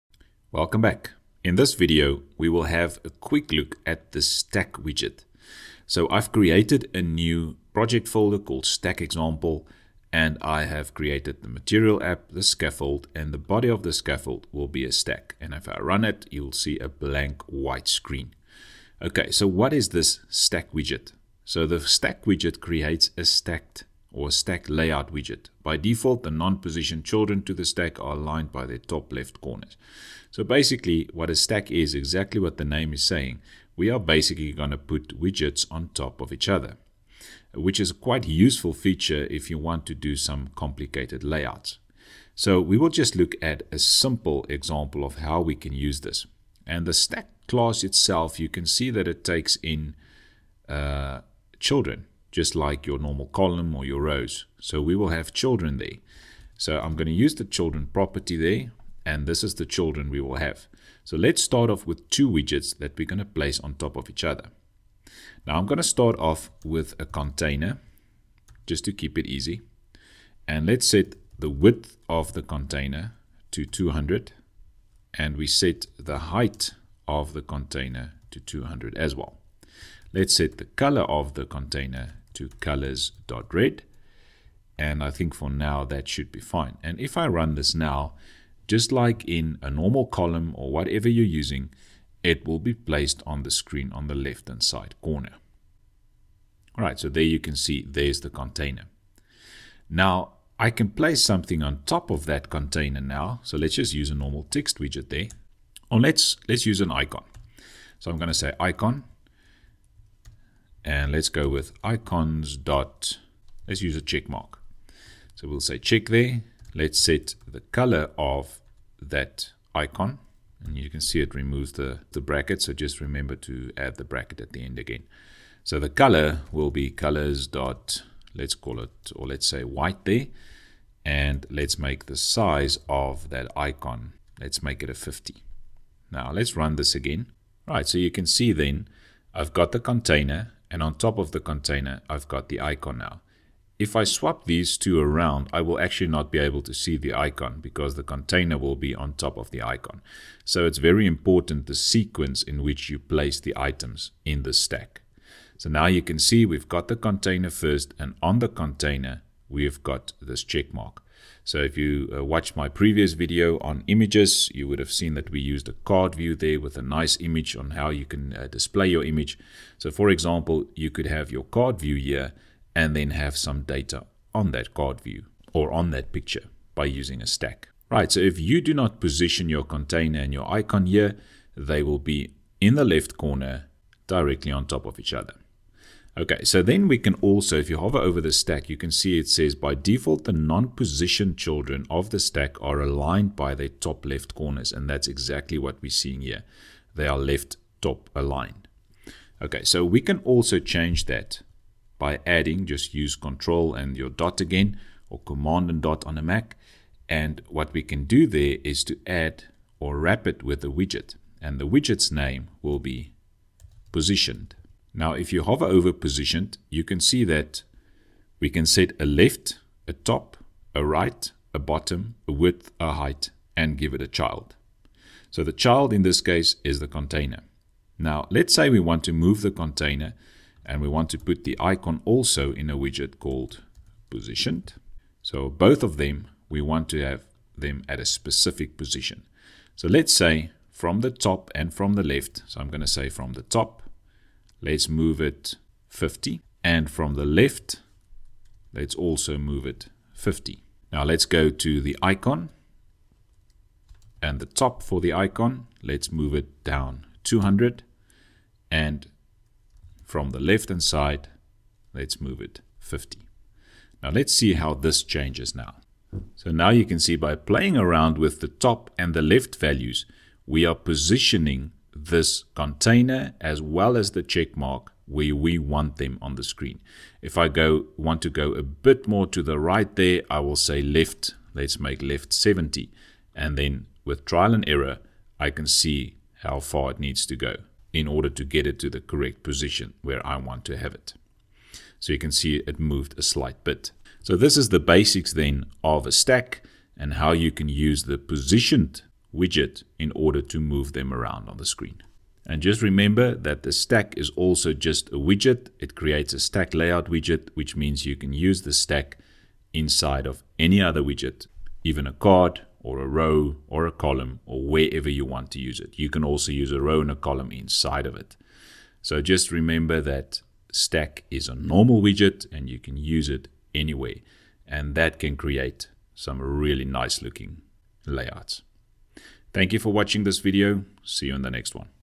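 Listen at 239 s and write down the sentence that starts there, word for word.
So let's say from the top and from the left.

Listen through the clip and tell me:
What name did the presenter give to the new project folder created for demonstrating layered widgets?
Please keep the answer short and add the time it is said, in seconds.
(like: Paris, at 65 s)
Stack Example, at 8 s.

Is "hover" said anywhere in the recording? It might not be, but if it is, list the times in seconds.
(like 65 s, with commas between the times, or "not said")
187 s, 215 s.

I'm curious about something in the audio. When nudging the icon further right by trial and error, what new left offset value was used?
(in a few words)
70.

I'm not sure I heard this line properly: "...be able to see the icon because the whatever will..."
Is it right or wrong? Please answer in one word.
wrong.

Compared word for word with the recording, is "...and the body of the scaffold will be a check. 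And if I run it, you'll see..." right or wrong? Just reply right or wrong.
wrong.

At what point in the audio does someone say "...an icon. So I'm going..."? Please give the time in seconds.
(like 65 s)
106 s.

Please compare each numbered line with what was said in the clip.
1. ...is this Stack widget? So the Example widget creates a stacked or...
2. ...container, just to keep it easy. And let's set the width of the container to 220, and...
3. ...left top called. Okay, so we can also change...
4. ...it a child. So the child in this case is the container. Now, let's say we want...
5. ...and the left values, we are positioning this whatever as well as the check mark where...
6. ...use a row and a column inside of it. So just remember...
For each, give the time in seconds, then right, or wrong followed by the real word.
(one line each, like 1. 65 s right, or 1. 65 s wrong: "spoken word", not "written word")
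1. 19 s wrong: "Stack", not "Example"
2. 67 s wrong: "200", not "220"
3. 197 s wrong: "aligned", not "called"
4. 223 s right
5. 268 s wrong: "container", not "whatever"
6. 316 s right.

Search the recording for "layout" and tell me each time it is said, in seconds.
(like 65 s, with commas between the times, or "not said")
24 s, 41 s, 306 s, 328 s.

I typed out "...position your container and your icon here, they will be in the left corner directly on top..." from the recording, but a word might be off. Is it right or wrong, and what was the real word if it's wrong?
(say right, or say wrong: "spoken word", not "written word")
right.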